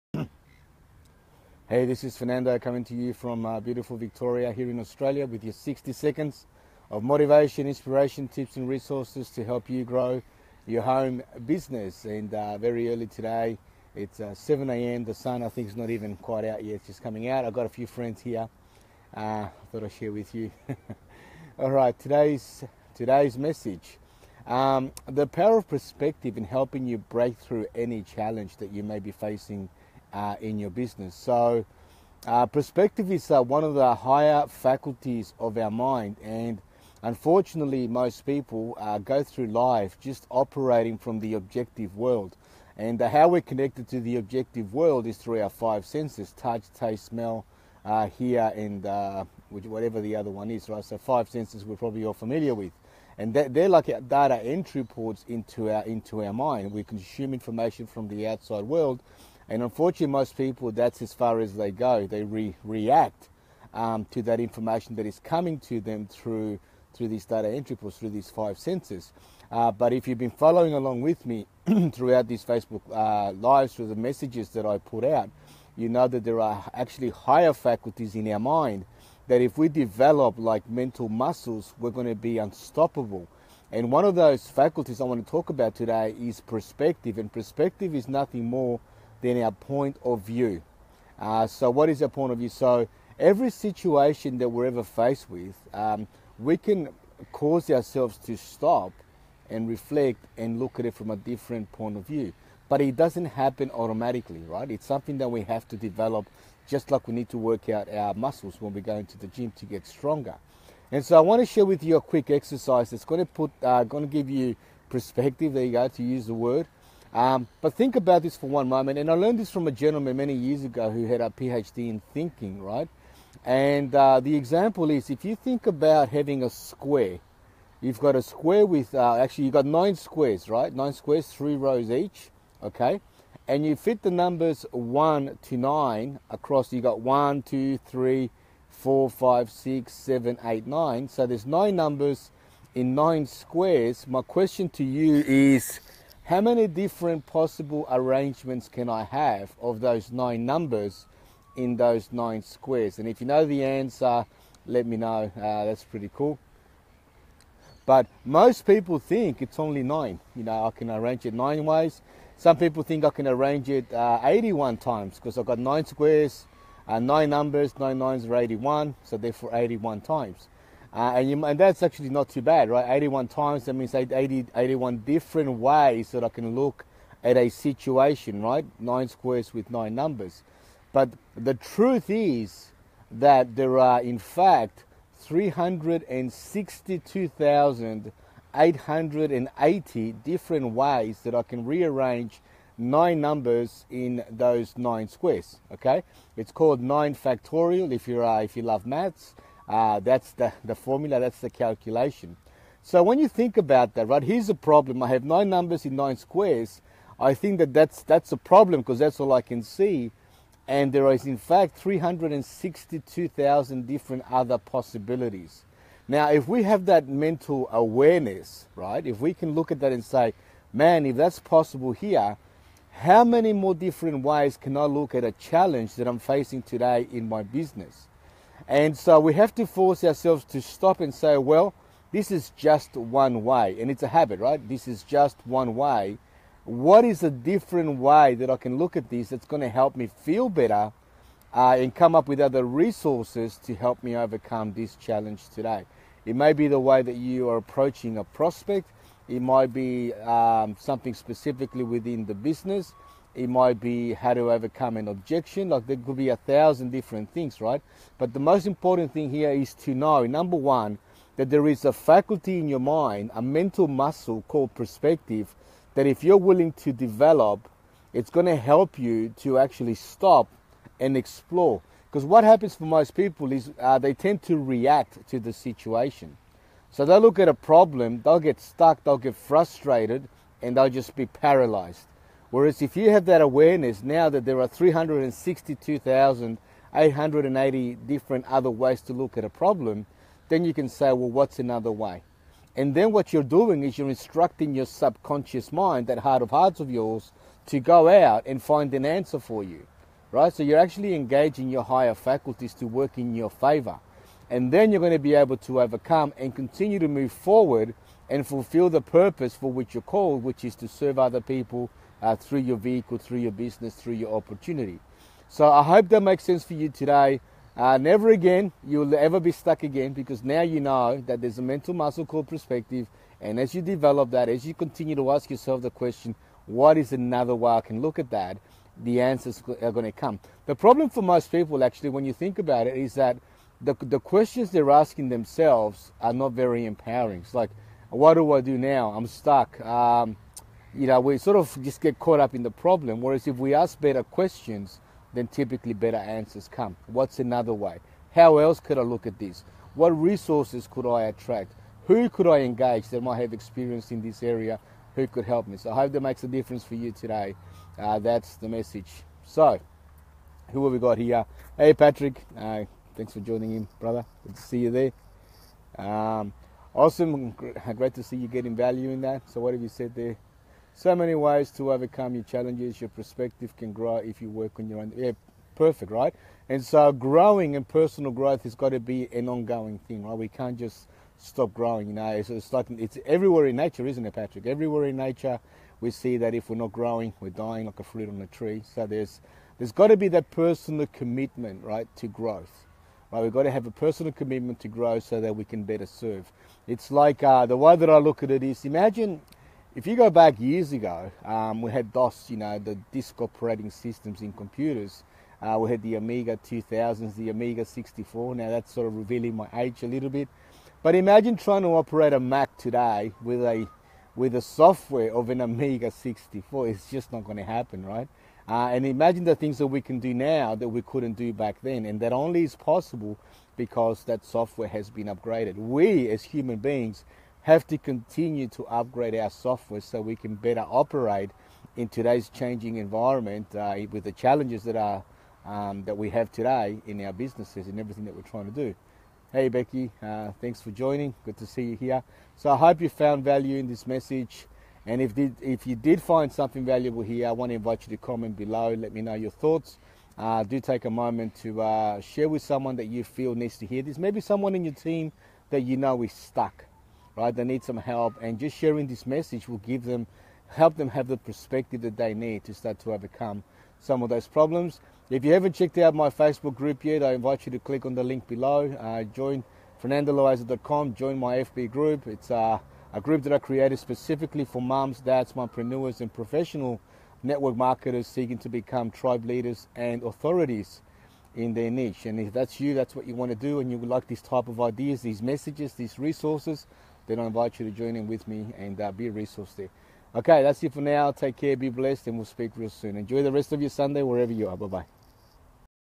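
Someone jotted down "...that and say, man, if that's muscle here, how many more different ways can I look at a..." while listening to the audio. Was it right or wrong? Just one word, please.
wrong.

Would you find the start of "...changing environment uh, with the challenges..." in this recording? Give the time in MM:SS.
07:12.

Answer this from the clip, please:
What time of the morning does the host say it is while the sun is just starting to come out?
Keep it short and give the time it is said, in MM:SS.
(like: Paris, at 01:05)
7 a.m., at 00:14.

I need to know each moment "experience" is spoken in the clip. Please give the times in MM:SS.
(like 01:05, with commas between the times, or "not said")
05:53.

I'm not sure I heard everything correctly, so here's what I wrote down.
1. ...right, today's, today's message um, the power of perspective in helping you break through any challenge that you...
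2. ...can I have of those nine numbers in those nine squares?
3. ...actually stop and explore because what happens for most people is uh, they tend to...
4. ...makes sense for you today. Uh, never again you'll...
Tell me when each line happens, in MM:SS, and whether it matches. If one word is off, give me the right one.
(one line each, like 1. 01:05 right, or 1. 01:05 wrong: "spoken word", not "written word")
1. 00:21 right
2. 02:28 right
3. 04:29 right
4. 05:16 right.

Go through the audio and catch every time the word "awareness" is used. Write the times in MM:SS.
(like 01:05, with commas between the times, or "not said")
03:37, 04:43.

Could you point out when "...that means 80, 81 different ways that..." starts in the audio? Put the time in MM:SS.
02:53.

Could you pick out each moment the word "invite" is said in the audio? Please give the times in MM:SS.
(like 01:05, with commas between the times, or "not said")
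07:27, 07:47, 08:07.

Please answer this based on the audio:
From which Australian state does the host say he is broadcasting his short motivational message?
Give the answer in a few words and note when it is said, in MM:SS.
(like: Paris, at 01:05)
Victoria, at 00:03.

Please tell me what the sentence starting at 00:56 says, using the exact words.
We consume information from the outside world, and unfortunately, most people, that's as far as they go.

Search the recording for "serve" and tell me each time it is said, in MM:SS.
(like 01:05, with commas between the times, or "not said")
05:10, 06:36.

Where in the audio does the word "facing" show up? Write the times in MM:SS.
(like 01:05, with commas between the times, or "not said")
00:29, 03:46.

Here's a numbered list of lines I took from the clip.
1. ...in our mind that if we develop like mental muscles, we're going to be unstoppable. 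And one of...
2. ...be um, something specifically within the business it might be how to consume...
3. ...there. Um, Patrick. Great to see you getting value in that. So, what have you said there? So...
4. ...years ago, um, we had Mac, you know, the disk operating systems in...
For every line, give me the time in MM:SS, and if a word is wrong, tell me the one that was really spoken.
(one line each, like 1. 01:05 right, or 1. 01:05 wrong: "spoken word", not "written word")
1. 01:18 right
2. 04:09 wrong: "overcome", not "consume"
3. 06:04 wrong: "Awesome", not "Patrick"
4. 06:40 wrong: "DOS", not "Mac".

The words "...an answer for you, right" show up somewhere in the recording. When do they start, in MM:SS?
04:58.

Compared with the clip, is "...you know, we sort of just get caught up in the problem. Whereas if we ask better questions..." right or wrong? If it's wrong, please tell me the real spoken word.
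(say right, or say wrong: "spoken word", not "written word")
right.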